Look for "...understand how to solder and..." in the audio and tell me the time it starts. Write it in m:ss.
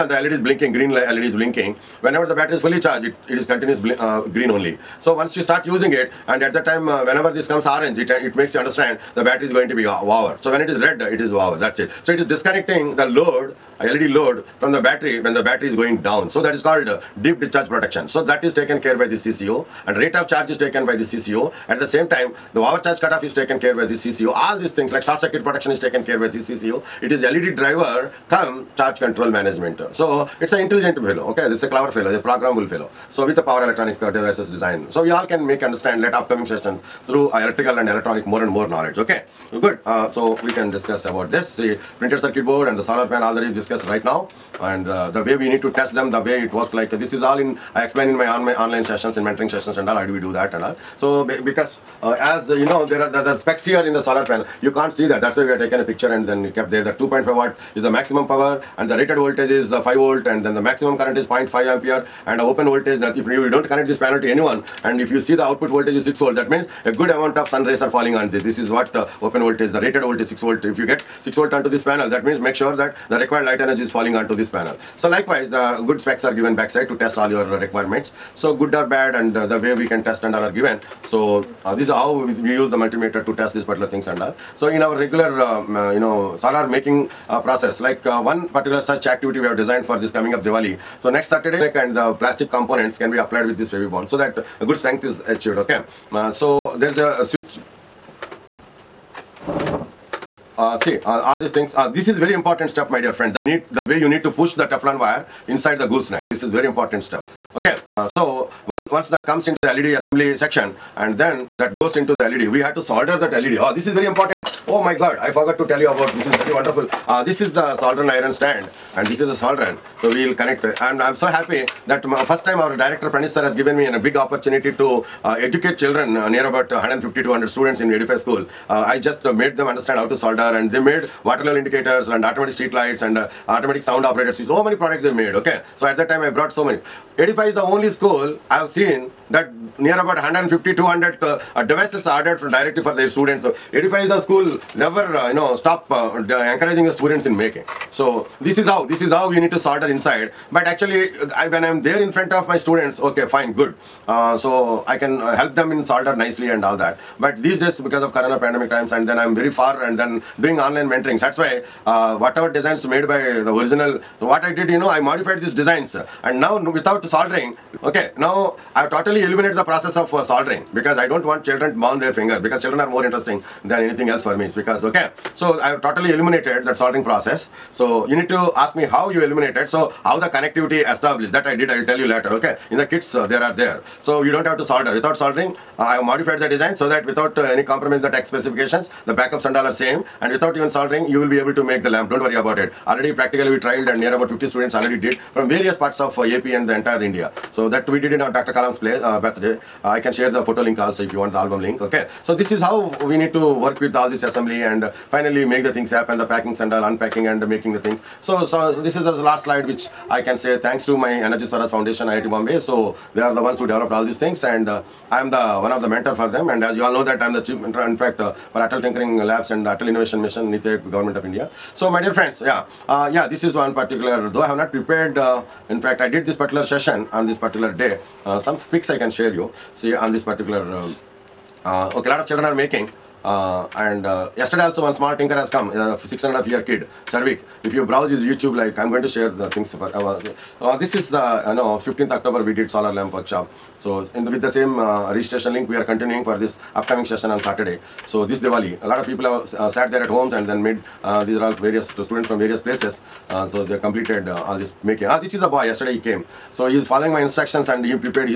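2:09.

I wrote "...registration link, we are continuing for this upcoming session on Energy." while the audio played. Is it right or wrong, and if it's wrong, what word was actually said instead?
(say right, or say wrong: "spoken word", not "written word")
wrong: "Saturday", not "Energy".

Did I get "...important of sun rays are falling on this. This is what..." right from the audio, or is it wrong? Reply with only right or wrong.
wrong.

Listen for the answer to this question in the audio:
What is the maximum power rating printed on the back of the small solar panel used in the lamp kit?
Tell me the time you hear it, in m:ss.
0:56.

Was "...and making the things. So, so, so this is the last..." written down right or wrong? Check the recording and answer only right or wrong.
right.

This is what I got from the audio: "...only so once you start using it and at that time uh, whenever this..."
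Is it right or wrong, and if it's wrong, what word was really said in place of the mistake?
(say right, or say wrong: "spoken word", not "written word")
right.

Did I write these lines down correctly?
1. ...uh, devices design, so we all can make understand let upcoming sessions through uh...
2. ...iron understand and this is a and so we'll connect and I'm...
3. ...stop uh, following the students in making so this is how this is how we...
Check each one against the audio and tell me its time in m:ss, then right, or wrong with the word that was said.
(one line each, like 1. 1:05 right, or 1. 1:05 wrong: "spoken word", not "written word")
1. 0:34 right
2. 1:58 wrong: "stand", not "understand"
3. 2:25 wrong: "encouraging", not "following".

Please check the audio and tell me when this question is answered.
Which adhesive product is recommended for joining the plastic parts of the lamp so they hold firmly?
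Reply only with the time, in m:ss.
1:33.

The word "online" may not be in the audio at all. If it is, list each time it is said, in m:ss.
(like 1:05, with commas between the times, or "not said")
0:48, 2:40.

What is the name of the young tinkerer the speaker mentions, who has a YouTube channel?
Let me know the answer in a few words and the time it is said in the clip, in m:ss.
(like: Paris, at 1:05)
Charvik, at 3:57.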